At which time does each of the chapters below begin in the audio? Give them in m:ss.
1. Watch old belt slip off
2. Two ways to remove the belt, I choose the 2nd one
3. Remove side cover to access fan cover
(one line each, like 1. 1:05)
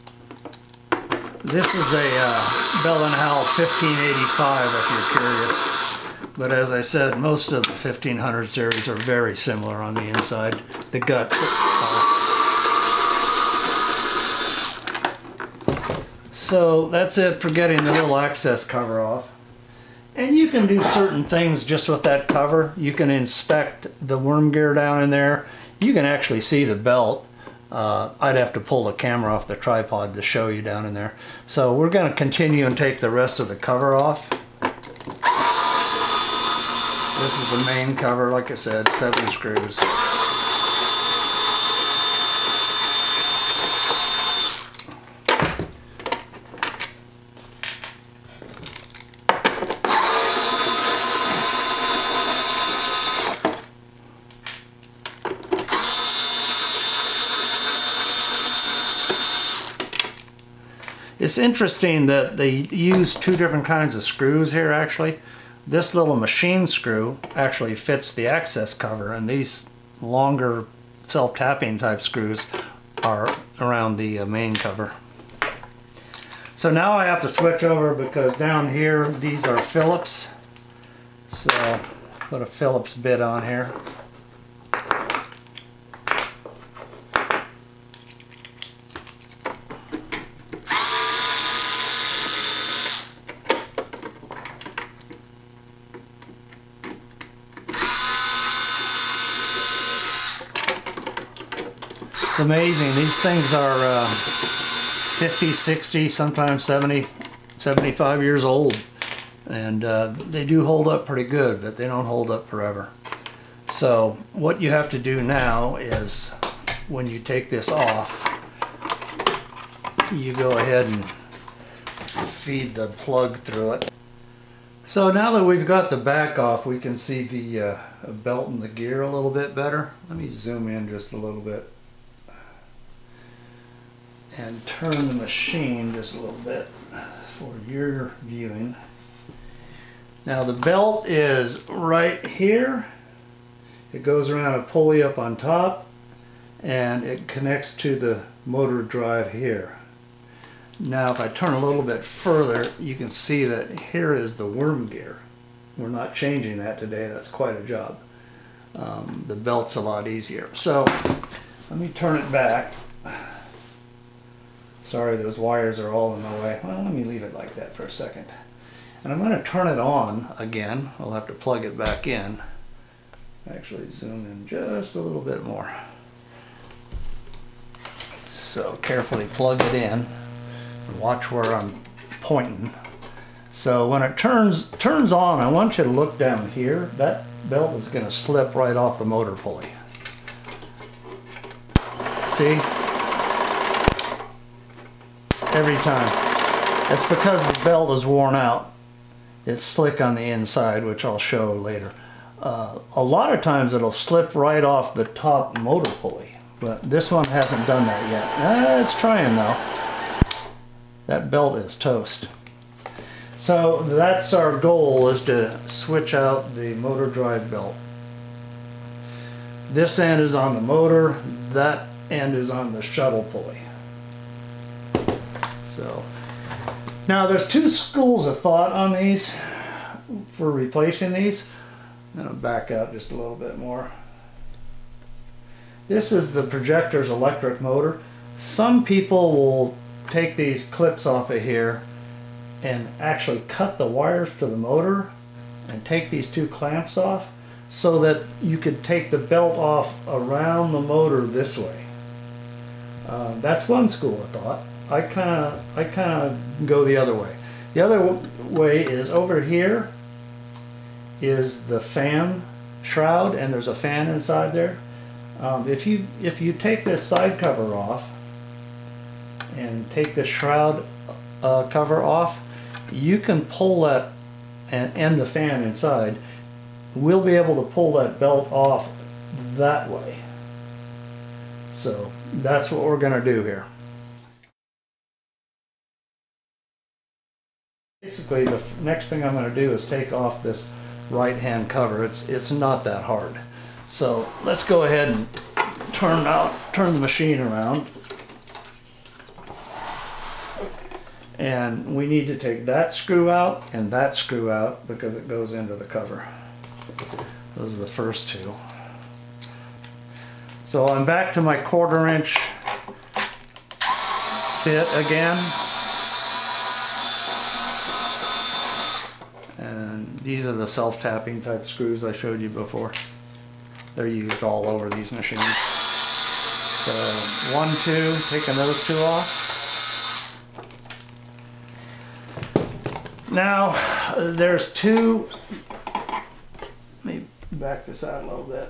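1. 3:02
2. 3:56
3. 5:00.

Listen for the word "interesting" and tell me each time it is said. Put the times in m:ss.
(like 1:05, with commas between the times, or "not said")
1:01.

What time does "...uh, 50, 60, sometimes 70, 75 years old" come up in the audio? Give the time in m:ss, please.
1:43.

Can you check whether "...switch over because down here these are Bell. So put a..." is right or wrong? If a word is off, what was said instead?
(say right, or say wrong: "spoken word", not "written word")
wrong: "Phillips", not "Bell".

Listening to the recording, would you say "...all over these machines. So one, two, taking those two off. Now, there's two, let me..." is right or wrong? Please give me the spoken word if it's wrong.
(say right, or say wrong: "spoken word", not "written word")
right.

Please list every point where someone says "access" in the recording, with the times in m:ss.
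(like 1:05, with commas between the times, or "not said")
0:18, 1:08.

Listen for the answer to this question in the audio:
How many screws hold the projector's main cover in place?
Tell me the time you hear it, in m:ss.
0:38.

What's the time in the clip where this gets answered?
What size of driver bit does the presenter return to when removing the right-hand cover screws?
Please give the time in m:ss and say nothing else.
5:11.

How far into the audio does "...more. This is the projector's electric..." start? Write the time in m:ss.
3:53.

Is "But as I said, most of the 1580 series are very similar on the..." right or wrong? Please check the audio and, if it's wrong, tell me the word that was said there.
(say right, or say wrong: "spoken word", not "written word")
wrong: "1500", not "1580".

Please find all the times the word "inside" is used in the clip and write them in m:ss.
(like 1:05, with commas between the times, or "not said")
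0:10, 3:20, 4:24, 4:35.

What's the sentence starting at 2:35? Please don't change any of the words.
We're not changing that today, that's quite a job.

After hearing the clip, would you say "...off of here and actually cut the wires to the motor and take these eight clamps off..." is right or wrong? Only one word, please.
wrong.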